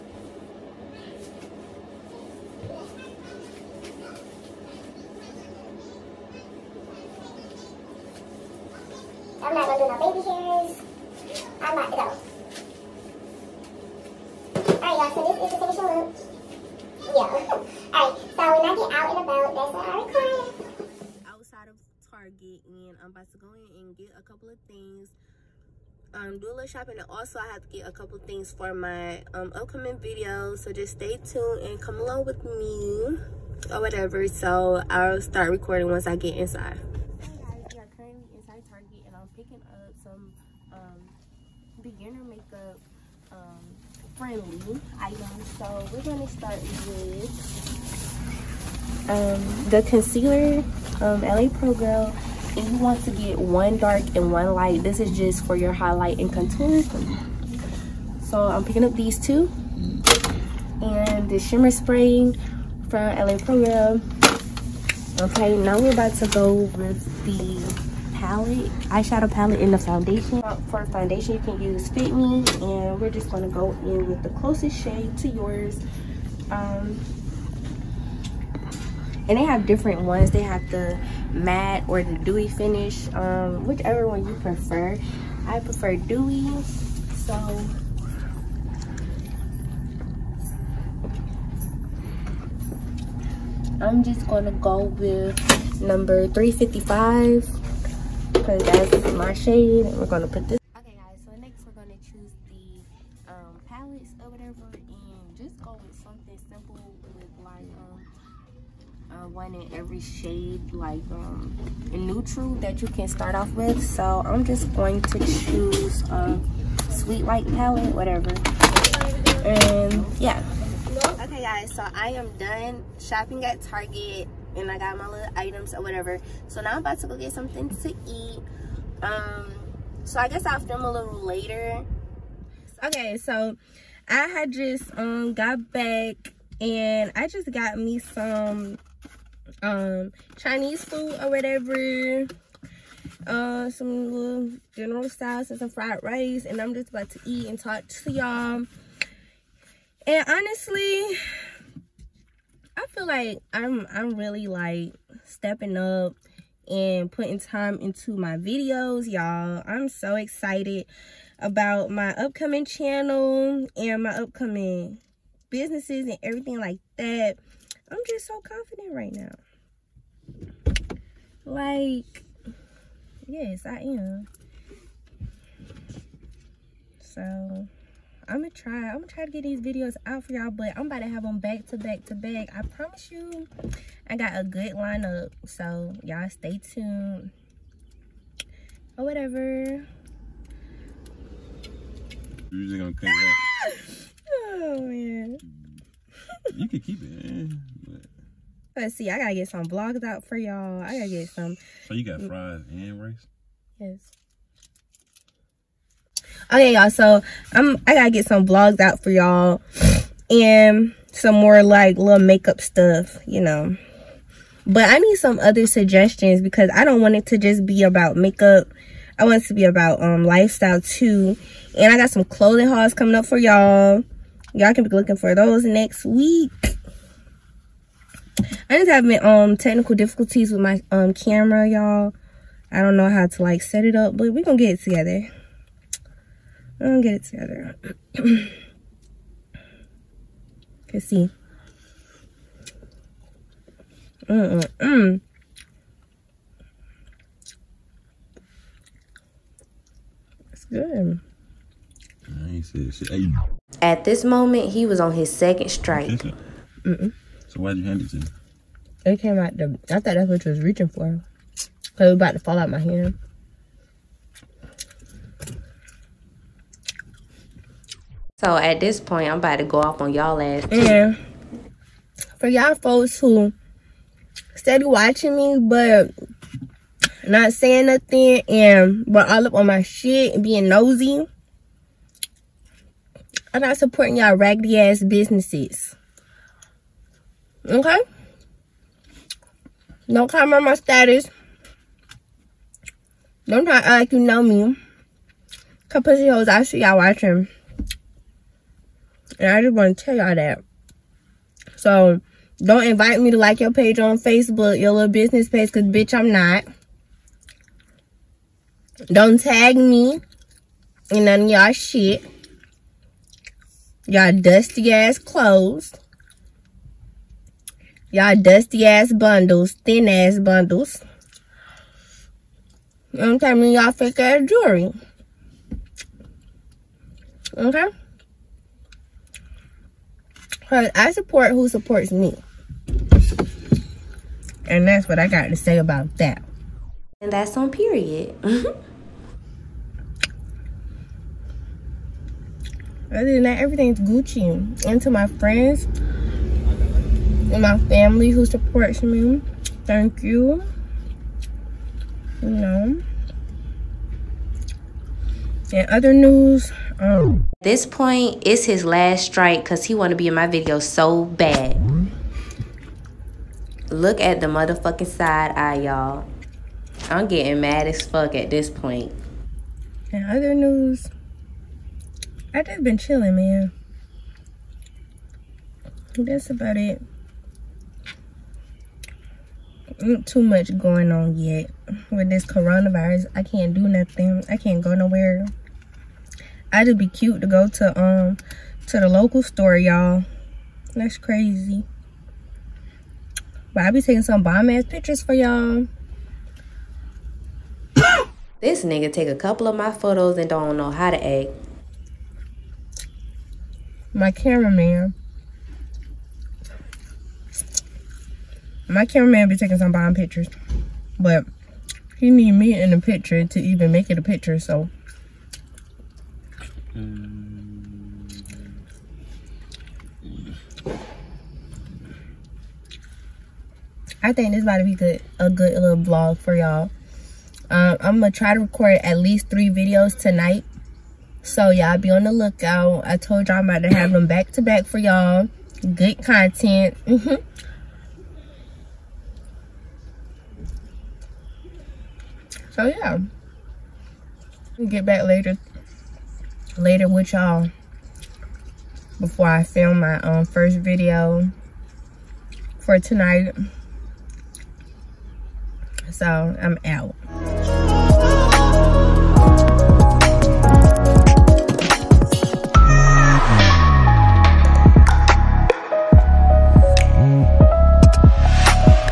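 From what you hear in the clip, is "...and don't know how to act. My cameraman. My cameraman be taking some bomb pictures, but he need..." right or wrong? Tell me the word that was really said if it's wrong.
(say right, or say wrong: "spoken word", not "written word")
right.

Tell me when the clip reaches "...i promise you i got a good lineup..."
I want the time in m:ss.
3:02.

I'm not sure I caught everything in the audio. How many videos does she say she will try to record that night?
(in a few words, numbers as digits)
3.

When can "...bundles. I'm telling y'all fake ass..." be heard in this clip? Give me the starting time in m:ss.
5:20.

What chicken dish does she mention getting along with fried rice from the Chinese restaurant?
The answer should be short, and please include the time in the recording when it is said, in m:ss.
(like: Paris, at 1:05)
General Tso's, at 2:24.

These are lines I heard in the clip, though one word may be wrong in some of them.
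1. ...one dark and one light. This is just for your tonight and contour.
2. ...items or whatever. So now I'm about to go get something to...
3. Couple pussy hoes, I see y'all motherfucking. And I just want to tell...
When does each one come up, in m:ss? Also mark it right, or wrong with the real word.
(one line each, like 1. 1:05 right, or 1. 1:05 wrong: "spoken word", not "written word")
1. 0:53 wrong: "highlight", not "tonight"
2. 2:05 right
3. 4:55 wrong: "watching", not "motherfucking".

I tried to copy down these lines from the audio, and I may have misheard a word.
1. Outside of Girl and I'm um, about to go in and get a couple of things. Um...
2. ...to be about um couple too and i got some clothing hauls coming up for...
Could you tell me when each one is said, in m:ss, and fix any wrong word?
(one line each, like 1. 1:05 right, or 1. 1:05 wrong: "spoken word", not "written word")
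1. 0:21 wrong: "Target", not "Girl"
2. 3:39 wrong: "lifestyle", not "couple".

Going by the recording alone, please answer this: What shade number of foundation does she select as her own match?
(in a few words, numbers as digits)
355.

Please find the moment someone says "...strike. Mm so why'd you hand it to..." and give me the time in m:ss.
4:15.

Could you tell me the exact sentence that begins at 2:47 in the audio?
I'm just so confident right now.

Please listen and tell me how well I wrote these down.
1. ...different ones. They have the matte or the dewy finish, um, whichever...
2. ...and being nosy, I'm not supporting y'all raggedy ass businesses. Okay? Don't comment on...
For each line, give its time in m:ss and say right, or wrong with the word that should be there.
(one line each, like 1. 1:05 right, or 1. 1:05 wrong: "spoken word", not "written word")
1. 1:19 right
2. 4:40 right.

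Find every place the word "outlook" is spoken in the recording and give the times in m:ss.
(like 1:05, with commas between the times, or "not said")
not said.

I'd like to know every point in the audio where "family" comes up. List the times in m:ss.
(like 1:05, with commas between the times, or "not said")
5:47.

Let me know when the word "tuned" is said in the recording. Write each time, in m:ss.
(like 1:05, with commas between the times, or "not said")
0:31, 3:06.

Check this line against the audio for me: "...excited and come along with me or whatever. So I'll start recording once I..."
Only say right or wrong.
wrong.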